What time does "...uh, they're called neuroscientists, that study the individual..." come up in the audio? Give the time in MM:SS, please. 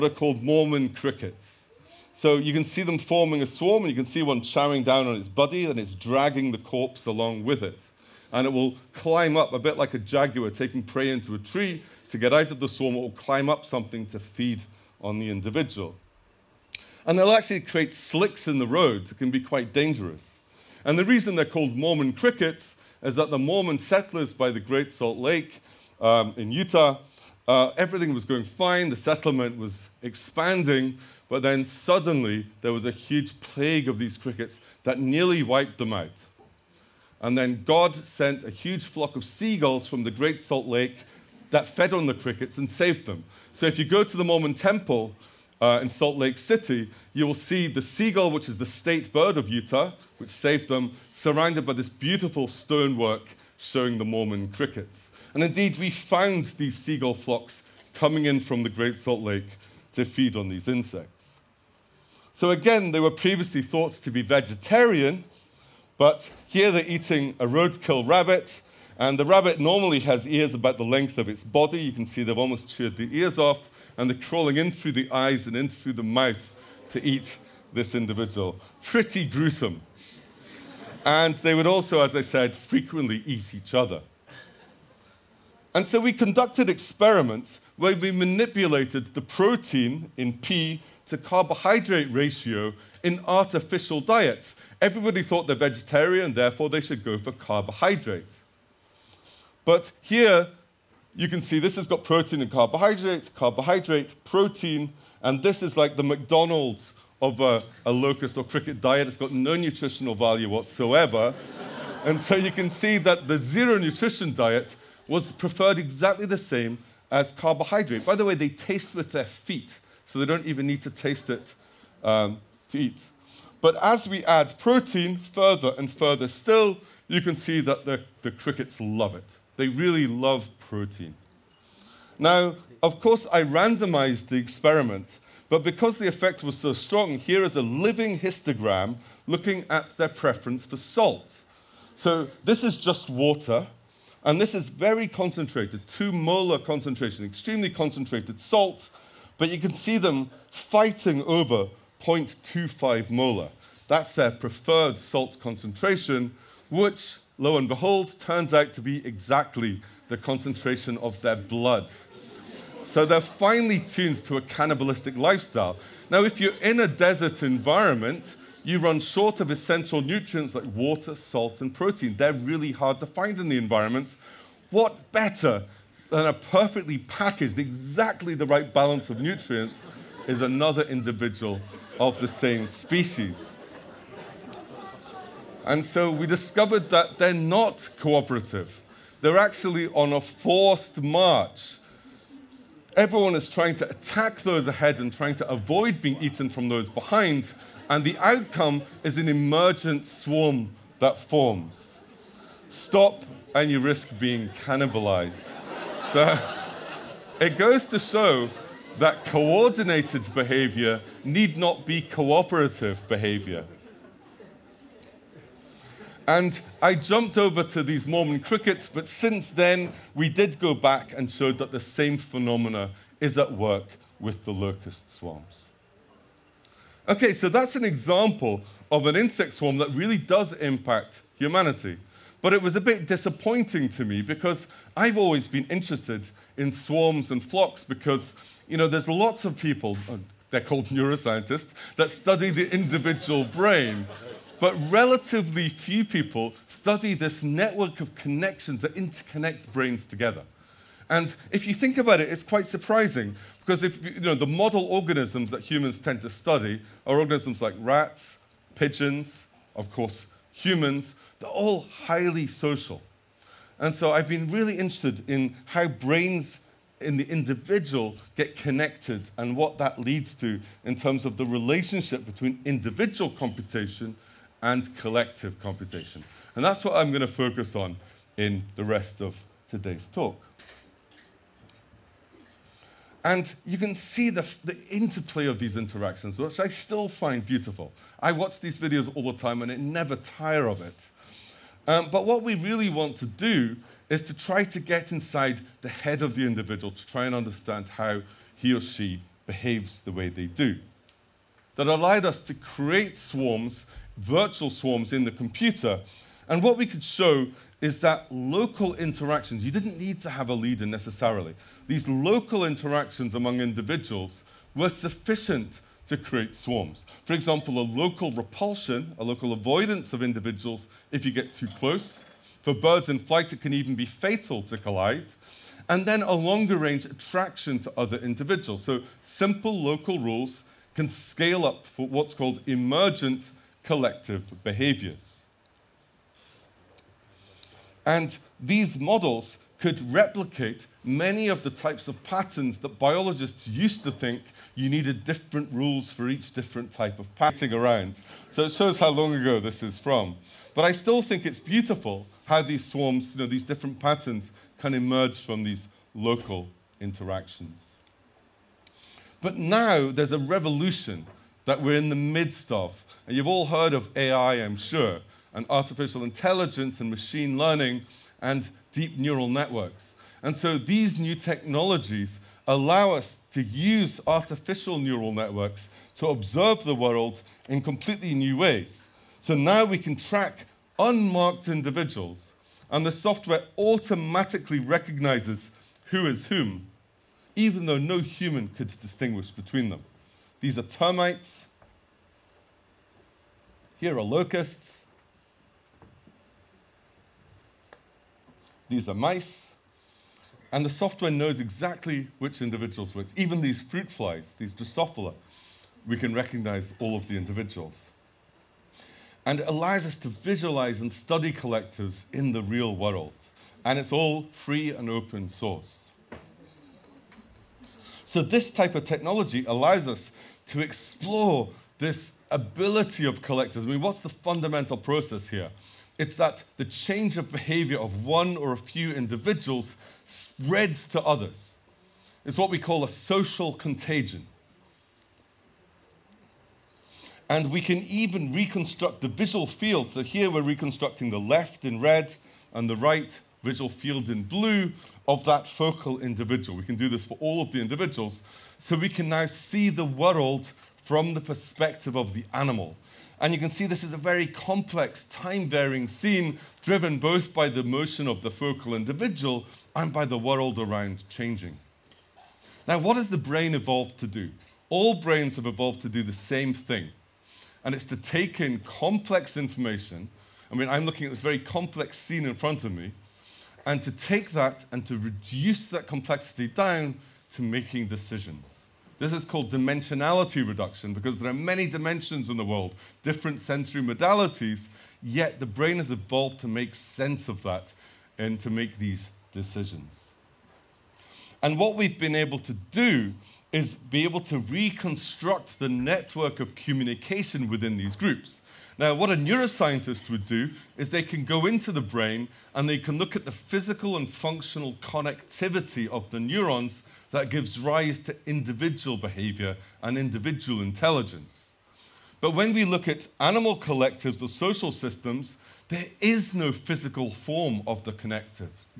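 04:00.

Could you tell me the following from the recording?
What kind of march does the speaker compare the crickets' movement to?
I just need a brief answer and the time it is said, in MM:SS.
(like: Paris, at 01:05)
Forced march, at 03:10.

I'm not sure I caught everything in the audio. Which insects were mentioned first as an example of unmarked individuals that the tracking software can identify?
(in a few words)
Termites.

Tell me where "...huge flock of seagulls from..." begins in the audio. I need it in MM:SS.
00:38.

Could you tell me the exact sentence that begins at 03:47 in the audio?
Okay, so that's an example of an insect swarm that really does impact humanity.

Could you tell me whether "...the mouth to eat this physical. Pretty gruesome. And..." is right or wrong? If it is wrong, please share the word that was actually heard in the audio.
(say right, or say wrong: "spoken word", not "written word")
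wrong: "individual", not "physical".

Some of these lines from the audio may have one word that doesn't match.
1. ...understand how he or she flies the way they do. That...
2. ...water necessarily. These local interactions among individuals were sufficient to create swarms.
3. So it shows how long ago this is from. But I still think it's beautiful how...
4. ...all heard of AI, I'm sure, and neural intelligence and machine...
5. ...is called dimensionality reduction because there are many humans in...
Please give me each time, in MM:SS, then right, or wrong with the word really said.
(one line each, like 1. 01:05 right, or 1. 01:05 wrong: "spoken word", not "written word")
1. 04:57 wrong: "behaves", not "flies"
2. 05:10 wrong: "leader", not "water"
3. 05:48 right
4. 06:03 wrong: "artificial", not "neural"
5. 07:59 wrong: "dimensions", not "humans".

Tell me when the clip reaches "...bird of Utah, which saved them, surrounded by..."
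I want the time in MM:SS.
00:49.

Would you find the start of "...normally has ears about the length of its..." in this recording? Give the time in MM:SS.
01:09.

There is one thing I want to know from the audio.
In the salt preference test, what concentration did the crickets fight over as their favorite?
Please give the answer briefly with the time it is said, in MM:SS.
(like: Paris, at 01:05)
0.25 molar, at 02:32.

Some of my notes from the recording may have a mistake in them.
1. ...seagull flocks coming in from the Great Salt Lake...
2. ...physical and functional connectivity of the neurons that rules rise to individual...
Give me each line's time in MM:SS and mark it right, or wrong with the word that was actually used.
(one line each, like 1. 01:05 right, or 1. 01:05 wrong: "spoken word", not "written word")
1. 00:56 right
2. 08:23 wrong: "gives", not "rules".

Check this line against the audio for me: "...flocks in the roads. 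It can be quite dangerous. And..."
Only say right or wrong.
wrong.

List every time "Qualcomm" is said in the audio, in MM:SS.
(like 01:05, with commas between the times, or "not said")
not said.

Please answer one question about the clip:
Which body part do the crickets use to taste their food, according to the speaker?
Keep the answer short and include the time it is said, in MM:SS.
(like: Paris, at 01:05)
Feet, at 01:59.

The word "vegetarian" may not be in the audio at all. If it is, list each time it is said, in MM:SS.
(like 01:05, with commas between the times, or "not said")
01:04, 01:35.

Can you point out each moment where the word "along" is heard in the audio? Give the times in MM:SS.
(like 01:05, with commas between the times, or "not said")
00:07.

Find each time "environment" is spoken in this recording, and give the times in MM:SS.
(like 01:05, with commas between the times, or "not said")
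02:47, 02:53.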